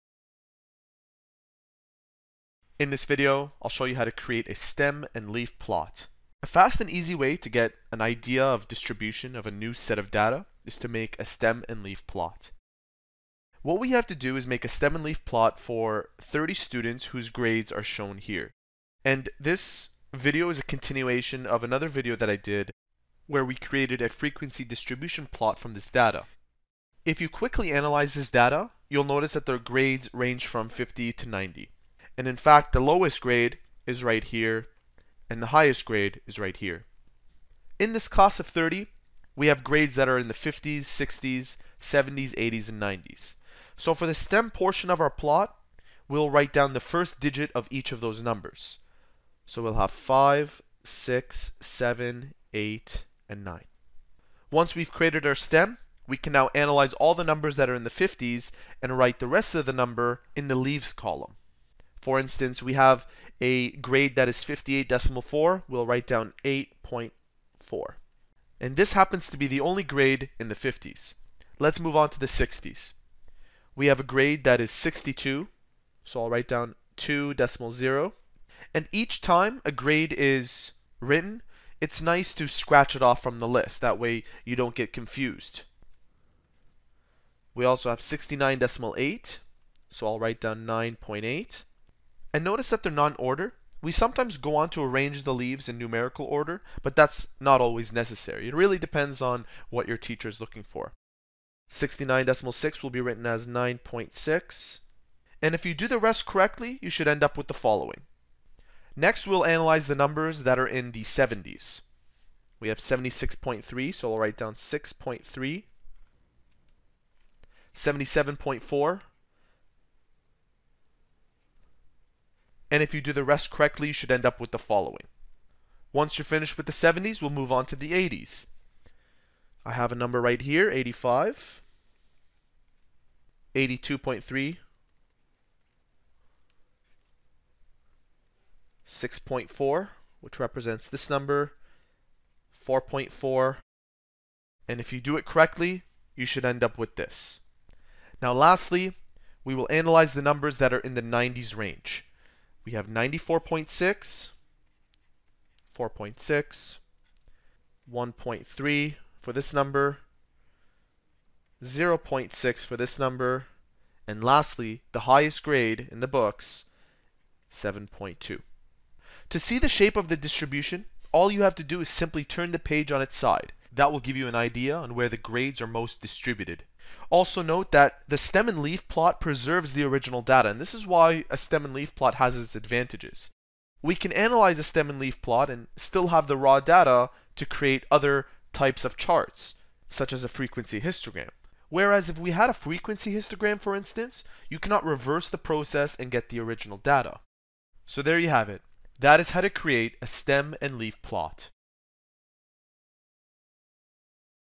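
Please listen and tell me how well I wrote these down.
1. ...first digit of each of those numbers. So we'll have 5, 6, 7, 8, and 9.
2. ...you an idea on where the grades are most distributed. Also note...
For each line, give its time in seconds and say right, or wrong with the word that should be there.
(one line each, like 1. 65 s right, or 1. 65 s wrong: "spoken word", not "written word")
1. 46 s right
2. 174 s right.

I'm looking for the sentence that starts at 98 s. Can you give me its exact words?
It really depends on what your teacher is looking for.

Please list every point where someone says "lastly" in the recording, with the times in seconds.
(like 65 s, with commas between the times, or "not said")
148 s, 164 s.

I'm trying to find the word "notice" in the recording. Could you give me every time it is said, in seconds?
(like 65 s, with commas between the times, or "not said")
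29 s, 92 s.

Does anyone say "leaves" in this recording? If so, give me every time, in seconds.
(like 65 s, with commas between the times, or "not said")
60 s, 95 s.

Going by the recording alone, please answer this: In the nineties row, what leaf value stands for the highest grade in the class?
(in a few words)
7.2.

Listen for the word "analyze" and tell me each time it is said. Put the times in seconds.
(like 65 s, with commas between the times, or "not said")
27 s, 56 s, 109 s, 149 s, 184 s.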